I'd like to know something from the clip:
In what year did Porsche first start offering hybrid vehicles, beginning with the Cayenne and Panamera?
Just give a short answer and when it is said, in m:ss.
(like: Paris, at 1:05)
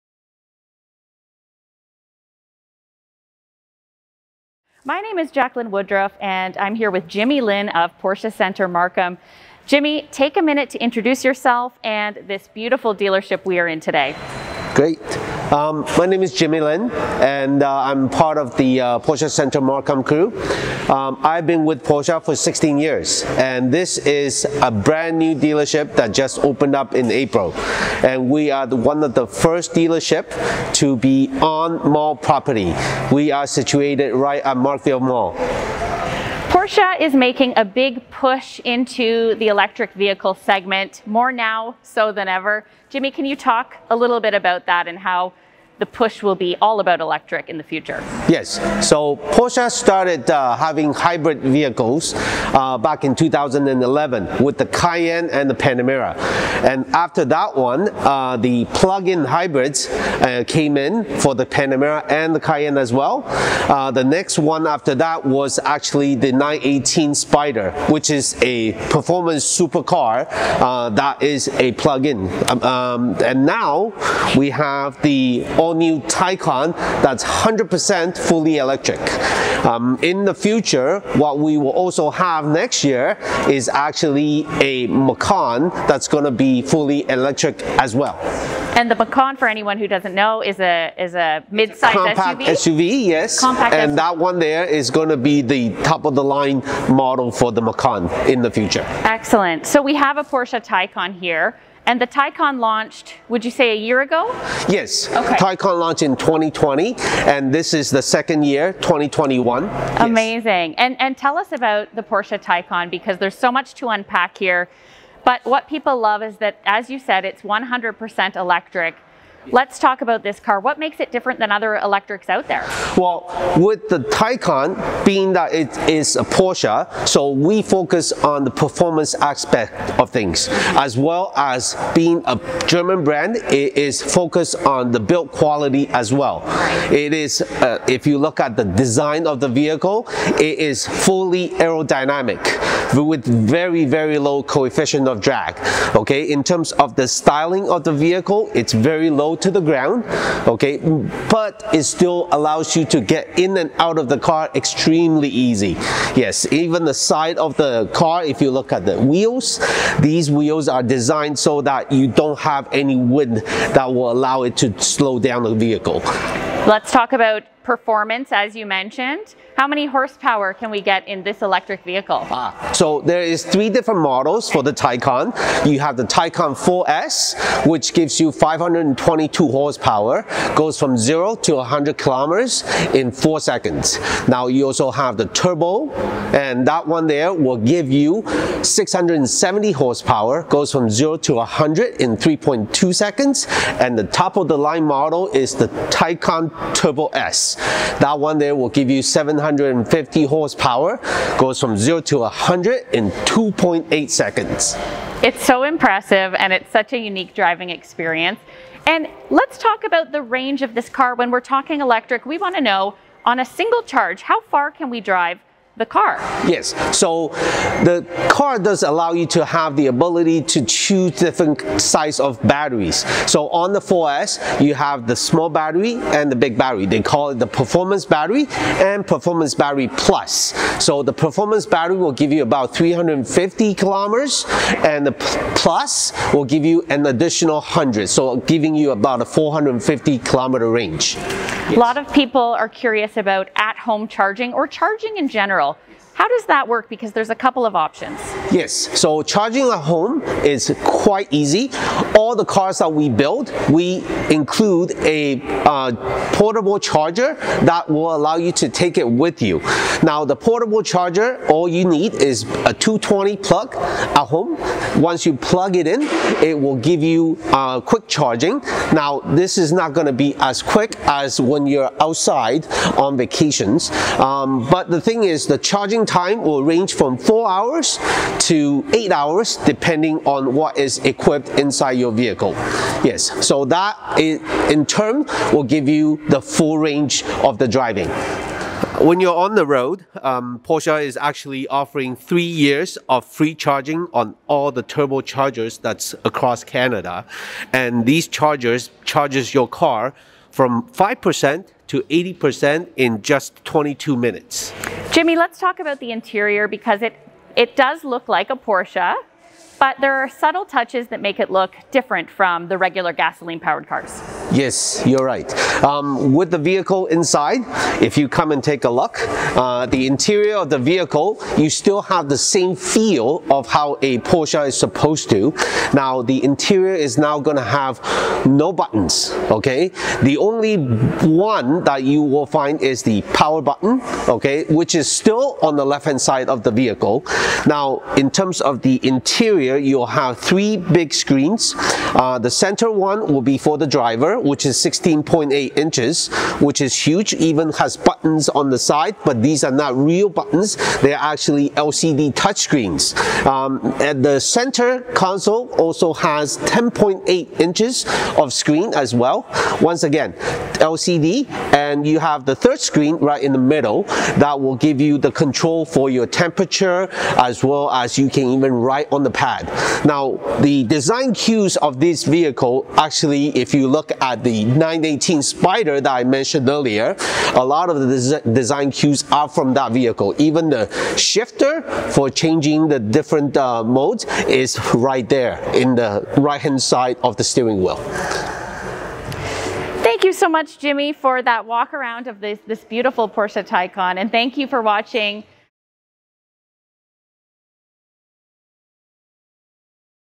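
2011, at 0:53.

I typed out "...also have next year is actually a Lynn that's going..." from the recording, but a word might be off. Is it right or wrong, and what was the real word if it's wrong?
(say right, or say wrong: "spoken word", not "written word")
wrong: "Macan", not "Lynn".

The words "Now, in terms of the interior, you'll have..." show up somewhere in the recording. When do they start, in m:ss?
5:37.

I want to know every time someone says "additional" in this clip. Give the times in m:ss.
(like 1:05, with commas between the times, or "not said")
3:57.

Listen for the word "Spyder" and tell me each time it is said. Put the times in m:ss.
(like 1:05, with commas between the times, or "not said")
1:07, 6:15.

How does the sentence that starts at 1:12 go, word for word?
Um, um, and now we have the all all-new Taycan that's 100% fully electric.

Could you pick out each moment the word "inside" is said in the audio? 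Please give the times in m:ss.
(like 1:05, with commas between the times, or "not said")
4:41, 5:17.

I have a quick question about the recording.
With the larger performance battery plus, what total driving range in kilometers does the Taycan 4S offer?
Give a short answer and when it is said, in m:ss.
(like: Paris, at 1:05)
450 km, at 3:59.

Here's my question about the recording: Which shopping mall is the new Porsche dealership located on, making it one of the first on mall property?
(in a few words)
Markville Mall.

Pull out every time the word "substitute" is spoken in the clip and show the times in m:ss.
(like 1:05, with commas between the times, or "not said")
not said.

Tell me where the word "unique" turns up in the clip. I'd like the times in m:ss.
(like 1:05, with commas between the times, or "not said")
3:26.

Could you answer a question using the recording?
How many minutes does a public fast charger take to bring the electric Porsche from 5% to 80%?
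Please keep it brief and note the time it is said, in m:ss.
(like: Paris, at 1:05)
22 minutes, at 5:03.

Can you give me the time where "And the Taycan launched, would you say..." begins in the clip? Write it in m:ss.
1:41.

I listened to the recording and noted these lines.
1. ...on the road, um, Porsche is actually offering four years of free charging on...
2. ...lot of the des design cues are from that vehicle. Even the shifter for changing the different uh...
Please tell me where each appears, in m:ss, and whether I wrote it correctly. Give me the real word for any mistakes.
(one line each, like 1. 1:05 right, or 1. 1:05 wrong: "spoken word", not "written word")
1. 4:49 wrong: "three", not "four"
2. 6:17 right.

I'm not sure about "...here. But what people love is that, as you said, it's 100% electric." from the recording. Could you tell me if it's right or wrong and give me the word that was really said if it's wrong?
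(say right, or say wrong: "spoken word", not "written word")
right.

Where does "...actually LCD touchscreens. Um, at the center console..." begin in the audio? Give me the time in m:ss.
5:51.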